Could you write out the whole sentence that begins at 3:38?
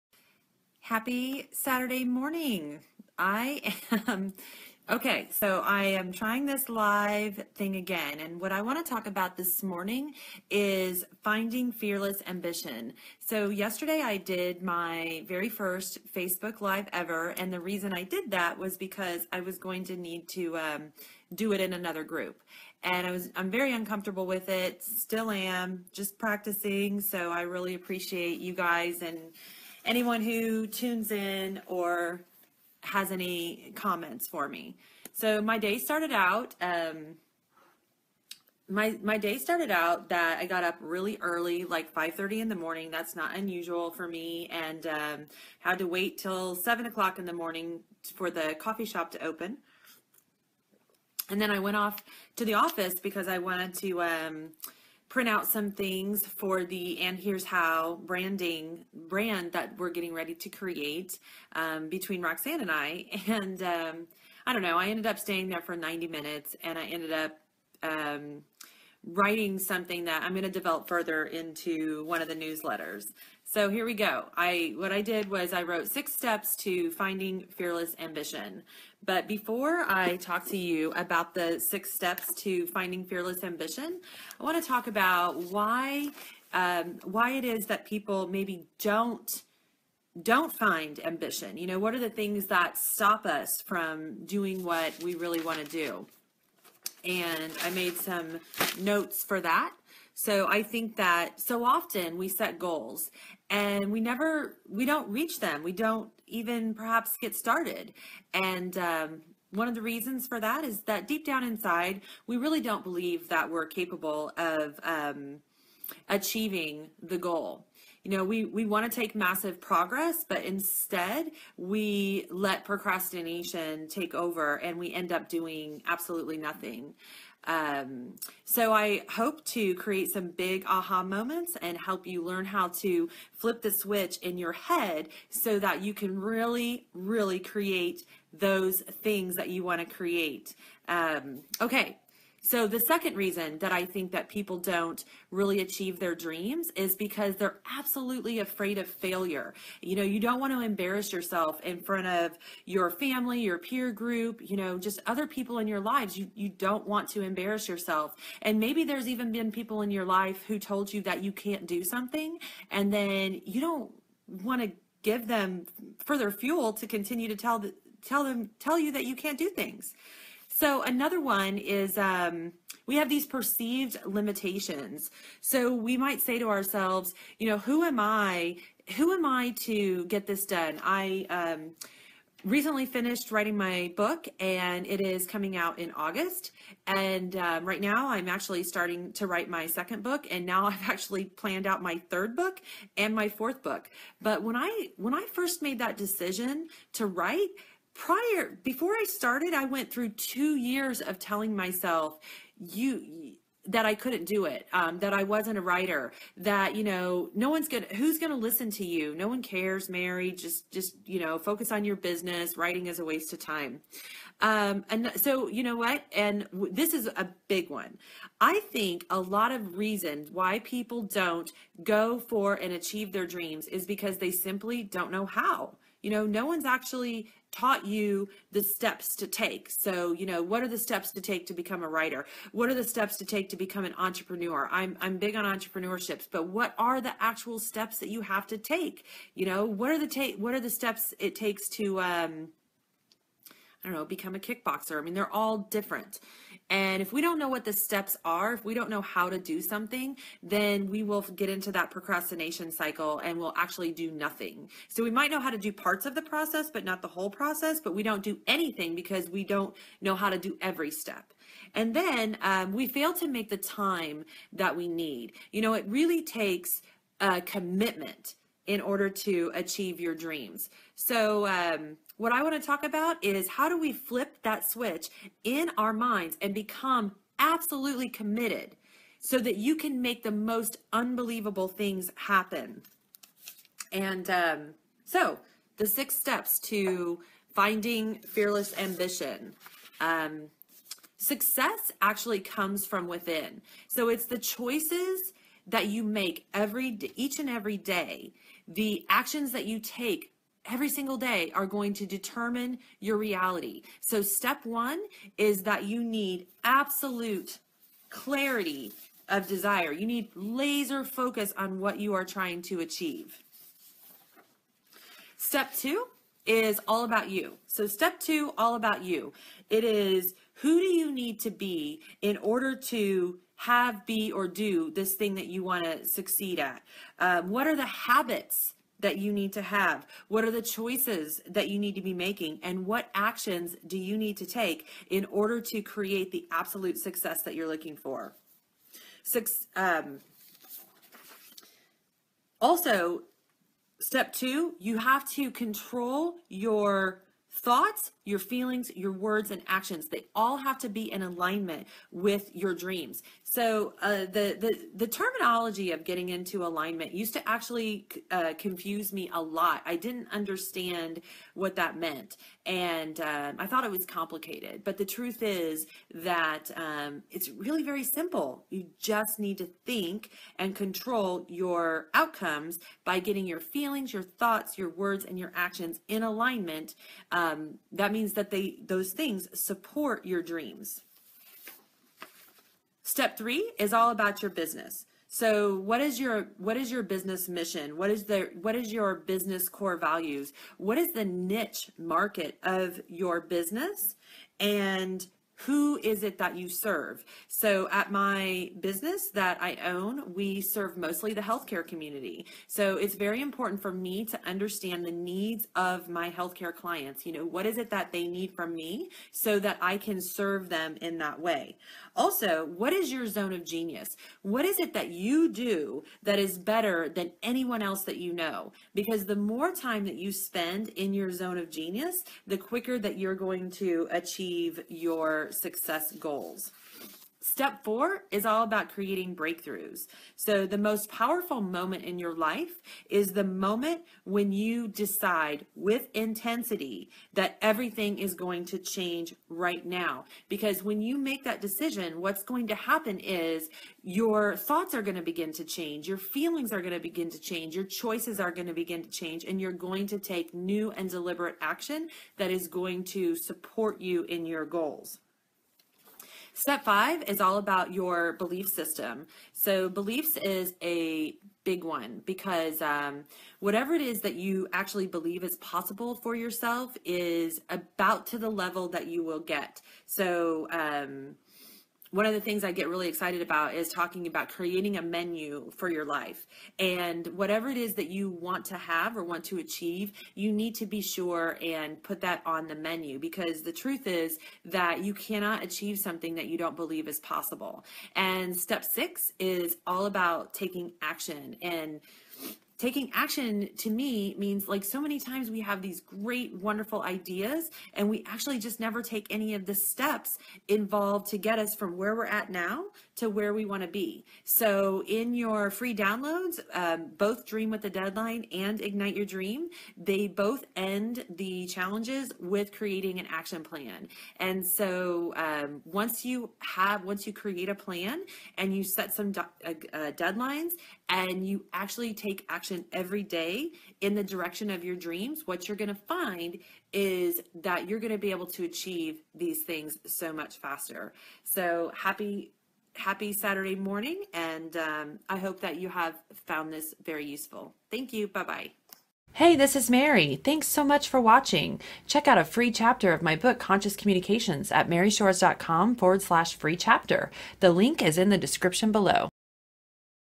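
I think a lot of reasons why people don't go for and achieve their dreams is because they simply don't know how.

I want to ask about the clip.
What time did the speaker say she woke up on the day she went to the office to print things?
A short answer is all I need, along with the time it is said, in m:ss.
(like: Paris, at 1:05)
5:30, at 0:41.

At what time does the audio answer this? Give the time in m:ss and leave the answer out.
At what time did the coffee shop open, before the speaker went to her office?
0:46.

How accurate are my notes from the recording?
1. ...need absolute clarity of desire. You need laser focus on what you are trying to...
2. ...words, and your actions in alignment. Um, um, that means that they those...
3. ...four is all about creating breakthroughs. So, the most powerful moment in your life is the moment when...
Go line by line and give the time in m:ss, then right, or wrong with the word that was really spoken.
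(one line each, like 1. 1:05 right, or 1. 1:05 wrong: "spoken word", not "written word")
1. 5:06 right
2. 6:14 right
3. 7:07 right.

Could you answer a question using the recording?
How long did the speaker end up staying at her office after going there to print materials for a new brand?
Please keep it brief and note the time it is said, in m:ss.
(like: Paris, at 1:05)
90 minutes, at 1:05.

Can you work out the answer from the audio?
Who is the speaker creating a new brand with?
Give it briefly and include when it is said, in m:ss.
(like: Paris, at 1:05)
Roxanne, at 1:02.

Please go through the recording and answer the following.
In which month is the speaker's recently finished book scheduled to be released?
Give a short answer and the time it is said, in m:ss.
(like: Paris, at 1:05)
August, at 3:05.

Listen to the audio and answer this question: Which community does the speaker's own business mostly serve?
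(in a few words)
healthcare community.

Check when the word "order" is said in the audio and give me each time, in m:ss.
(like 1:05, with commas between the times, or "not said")
4:28, 5:22, 5:35.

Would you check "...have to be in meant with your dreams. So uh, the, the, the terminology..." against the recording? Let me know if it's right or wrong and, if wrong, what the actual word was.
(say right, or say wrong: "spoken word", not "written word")
wrong: "alignment", not "meant".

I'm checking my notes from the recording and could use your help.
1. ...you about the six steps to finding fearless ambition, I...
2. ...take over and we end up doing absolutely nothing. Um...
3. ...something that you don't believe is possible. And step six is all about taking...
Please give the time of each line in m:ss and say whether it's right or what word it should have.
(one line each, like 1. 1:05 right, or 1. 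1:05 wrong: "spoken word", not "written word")
1. 1:20 right
2. 2:03 right
3. 8:05 right.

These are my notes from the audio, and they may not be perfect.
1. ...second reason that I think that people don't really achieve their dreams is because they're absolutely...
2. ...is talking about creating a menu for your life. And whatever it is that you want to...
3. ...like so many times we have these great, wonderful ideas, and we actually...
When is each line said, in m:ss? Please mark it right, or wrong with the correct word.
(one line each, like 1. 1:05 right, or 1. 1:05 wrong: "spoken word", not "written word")
1. 2:22 right
2. 7:53 right
3. 8:14 right.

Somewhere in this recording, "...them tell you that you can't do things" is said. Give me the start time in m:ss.
2:48.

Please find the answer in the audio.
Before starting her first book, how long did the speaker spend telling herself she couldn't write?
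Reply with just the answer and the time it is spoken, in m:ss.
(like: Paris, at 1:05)
two years, at 3:20.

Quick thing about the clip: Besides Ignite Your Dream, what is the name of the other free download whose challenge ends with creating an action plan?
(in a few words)
Dream with the Deadline.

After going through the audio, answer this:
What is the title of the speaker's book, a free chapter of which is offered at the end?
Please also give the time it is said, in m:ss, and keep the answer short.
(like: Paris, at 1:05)
Conscious Communications, at 9:03.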